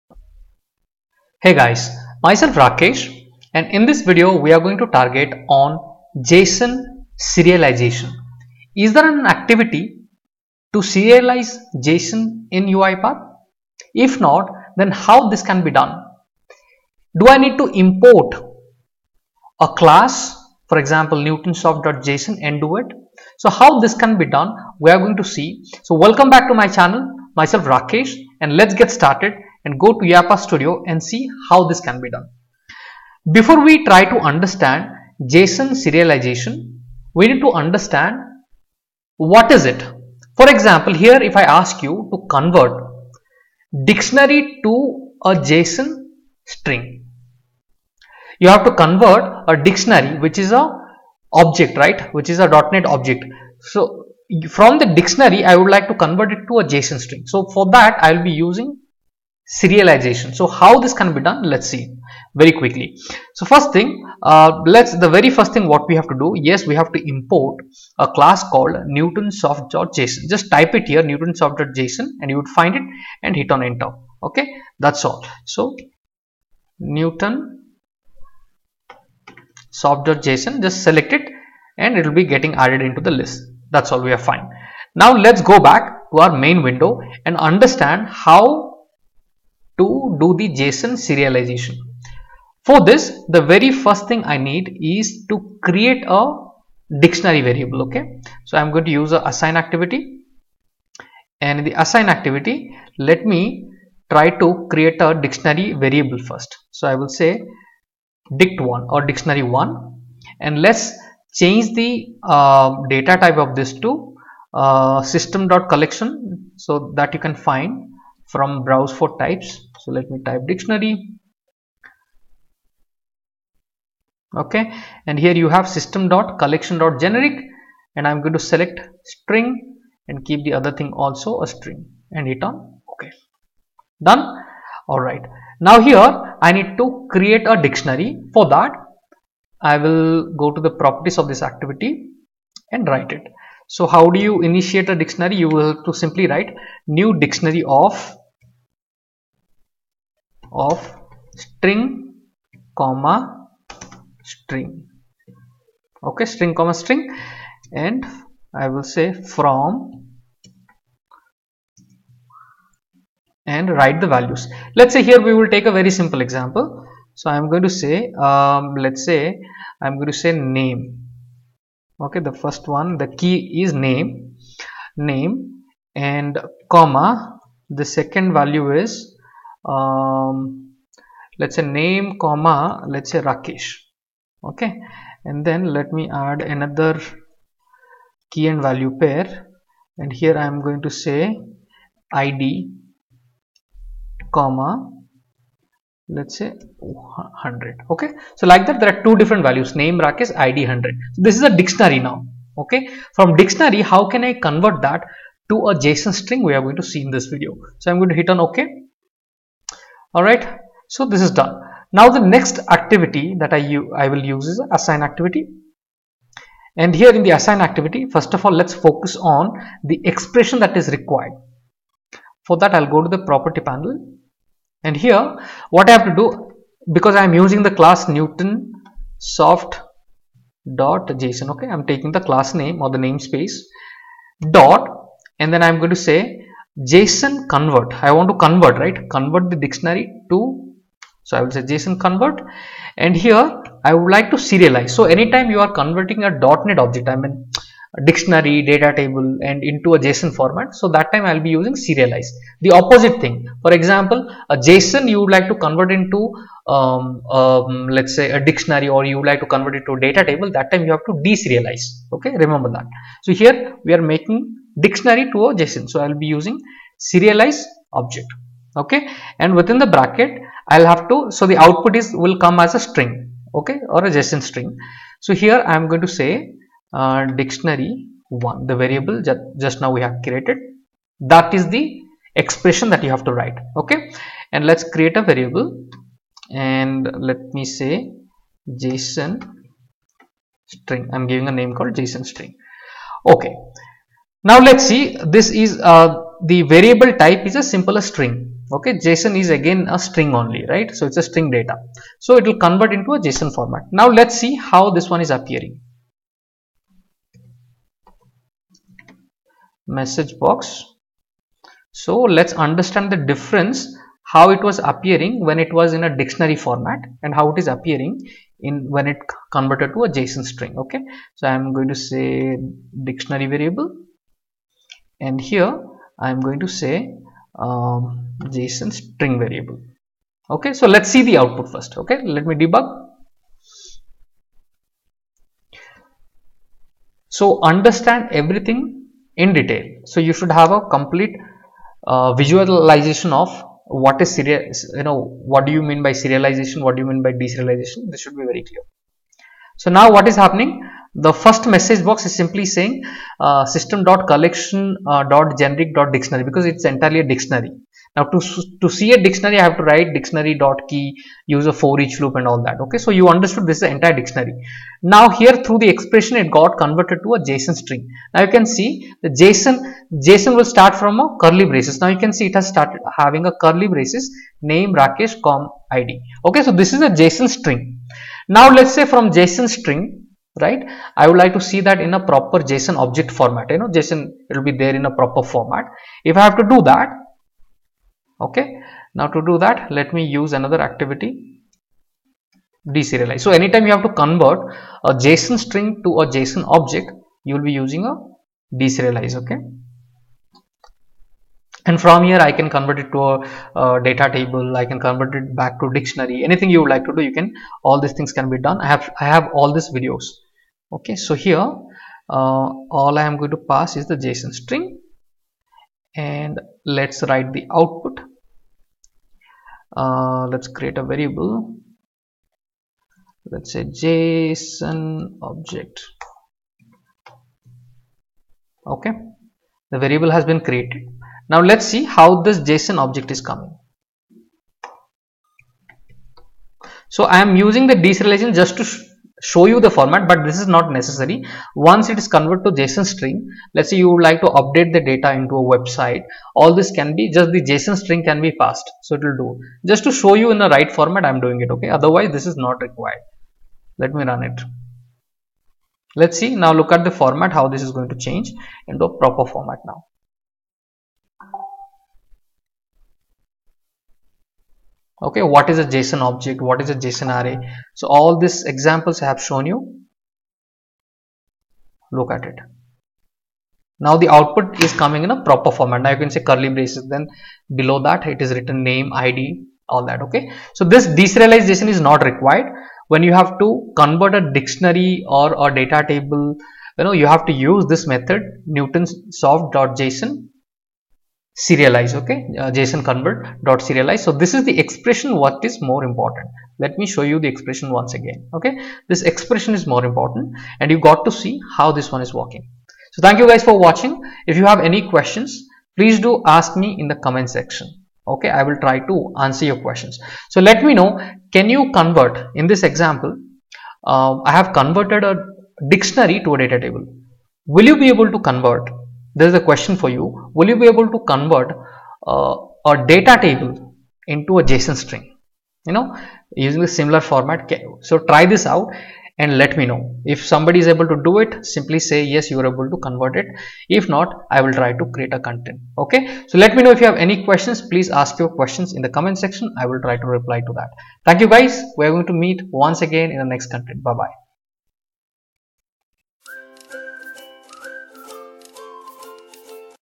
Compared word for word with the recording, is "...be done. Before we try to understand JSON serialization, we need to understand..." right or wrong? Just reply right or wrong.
right.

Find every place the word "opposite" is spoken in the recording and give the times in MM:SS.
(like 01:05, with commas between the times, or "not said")
04:12.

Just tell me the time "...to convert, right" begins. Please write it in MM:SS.
03:58.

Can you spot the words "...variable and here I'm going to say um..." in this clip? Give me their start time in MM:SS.
05:23.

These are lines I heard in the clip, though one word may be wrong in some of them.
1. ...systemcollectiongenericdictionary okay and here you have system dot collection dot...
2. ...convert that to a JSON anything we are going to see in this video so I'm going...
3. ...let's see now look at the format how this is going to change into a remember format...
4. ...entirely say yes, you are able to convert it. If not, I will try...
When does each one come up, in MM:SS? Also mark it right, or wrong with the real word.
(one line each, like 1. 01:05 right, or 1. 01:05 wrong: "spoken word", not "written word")
1. 02:00 wrong: "dictionary", not "systemcollectiongenericdictionary"
2. 03:24 wrong: "string", not "anything"
3. 07:36 wrong: "proper", not "remember"
4. 08:51 wrong: "simply", not "entirely".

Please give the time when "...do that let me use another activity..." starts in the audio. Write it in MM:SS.
06:29.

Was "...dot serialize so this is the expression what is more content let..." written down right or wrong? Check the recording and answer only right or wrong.
wrong.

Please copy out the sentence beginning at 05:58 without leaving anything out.
Now to, to see a dictionary, I have to write dictionary.key, use a for each loop and all that.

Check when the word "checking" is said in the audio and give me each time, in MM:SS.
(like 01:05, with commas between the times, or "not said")
not said.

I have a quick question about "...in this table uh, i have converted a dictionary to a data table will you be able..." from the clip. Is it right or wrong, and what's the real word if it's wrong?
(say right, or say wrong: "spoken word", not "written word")
wrong: "example", not "table".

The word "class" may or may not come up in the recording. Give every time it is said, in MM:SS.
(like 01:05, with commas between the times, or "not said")
00:19, 01:08, 03:47, 03:52.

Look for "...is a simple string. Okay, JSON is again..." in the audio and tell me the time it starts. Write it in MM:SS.
04:57.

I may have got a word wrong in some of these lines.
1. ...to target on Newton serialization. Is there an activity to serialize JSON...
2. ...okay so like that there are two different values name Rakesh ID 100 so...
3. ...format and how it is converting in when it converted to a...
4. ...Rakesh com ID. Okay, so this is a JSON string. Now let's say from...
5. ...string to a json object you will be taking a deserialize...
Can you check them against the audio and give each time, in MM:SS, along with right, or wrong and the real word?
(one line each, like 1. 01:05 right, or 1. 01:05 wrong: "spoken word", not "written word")
1. 00:04 wrong: "JSON", not "Newton"
2. 03:17 right
3. 05:16 wrong: "appearing", not "converting"
4. 06:14 right
5. 06:35 wrong: "using", not "taking".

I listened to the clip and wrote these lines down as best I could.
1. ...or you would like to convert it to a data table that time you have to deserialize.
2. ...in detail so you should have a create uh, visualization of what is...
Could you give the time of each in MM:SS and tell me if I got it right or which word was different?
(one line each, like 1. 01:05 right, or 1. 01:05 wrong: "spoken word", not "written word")
1. 04:18 right
2. 05:39 wrong: "complete", not "create".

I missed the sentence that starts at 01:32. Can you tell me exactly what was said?
For this, the very first thing I need is to create a dictionary variable.